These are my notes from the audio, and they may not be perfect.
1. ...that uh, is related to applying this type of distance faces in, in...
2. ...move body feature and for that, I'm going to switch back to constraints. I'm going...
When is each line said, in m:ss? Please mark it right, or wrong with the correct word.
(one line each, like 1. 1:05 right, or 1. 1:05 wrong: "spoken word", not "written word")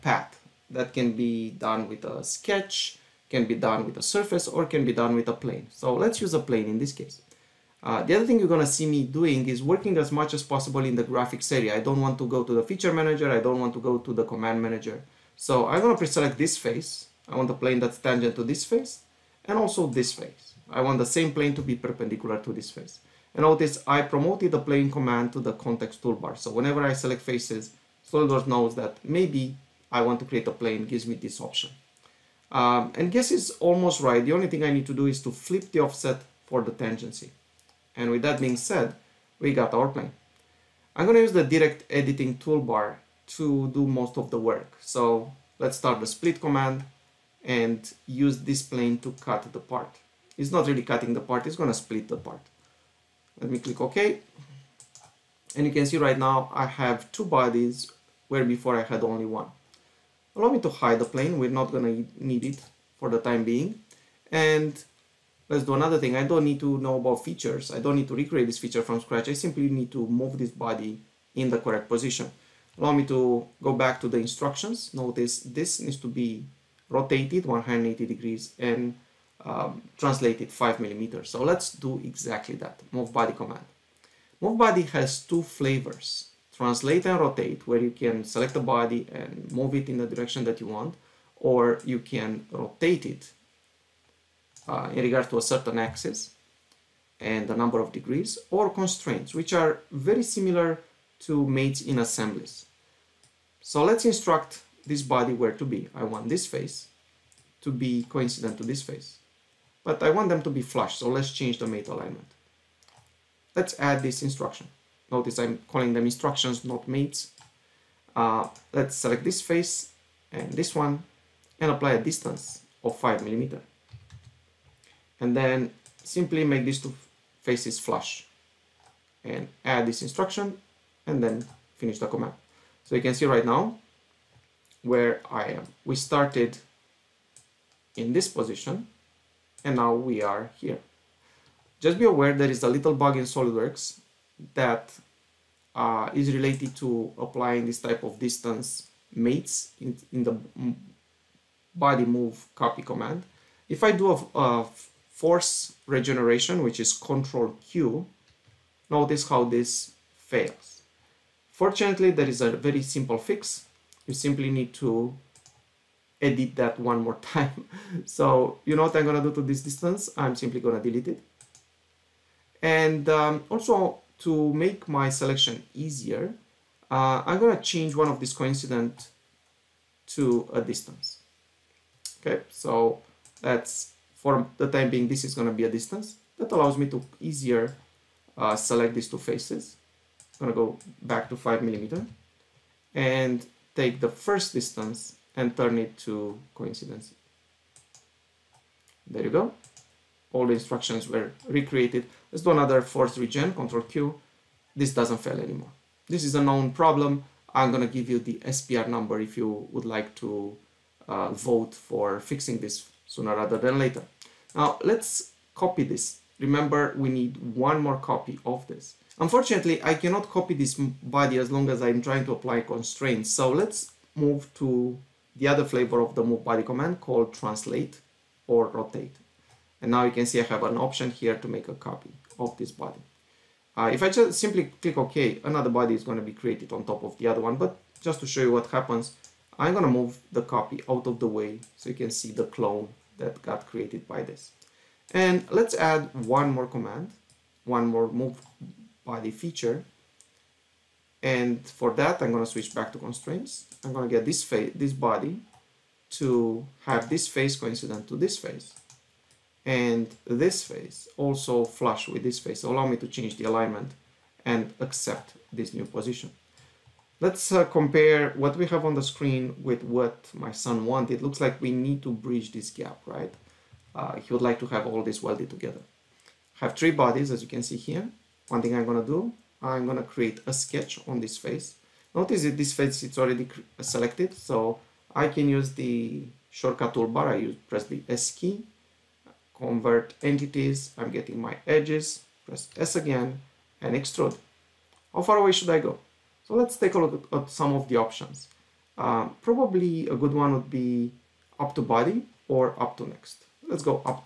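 1. 2:24 wrong: "mates", not "faces"
2. 4:08 right.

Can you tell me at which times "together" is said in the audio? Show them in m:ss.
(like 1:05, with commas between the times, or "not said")
4:35.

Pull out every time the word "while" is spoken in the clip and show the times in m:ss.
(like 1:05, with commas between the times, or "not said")
not said.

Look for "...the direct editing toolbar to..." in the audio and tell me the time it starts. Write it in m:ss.
0:41.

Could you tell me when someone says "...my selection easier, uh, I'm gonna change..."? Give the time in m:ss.
2:54.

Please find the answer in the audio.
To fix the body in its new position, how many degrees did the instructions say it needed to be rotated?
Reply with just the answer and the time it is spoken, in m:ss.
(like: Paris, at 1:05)
180, at 1:17.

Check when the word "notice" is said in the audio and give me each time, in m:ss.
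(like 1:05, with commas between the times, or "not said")
0:23, 1:14, 1:55, 2:38, 4:42.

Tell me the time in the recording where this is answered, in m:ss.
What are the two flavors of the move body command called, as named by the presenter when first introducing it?
1:26.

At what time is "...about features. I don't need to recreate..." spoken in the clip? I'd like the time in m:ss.
1:06.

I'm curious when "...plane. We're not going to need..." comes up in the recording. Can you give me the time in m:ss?
1:01.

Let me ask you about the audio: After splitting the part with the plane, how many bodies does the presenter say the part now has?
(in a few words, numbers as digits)
2.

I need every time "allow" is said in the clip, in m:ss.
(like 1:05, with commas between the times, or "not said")
1:00, 1:12, 3:06, 4:22.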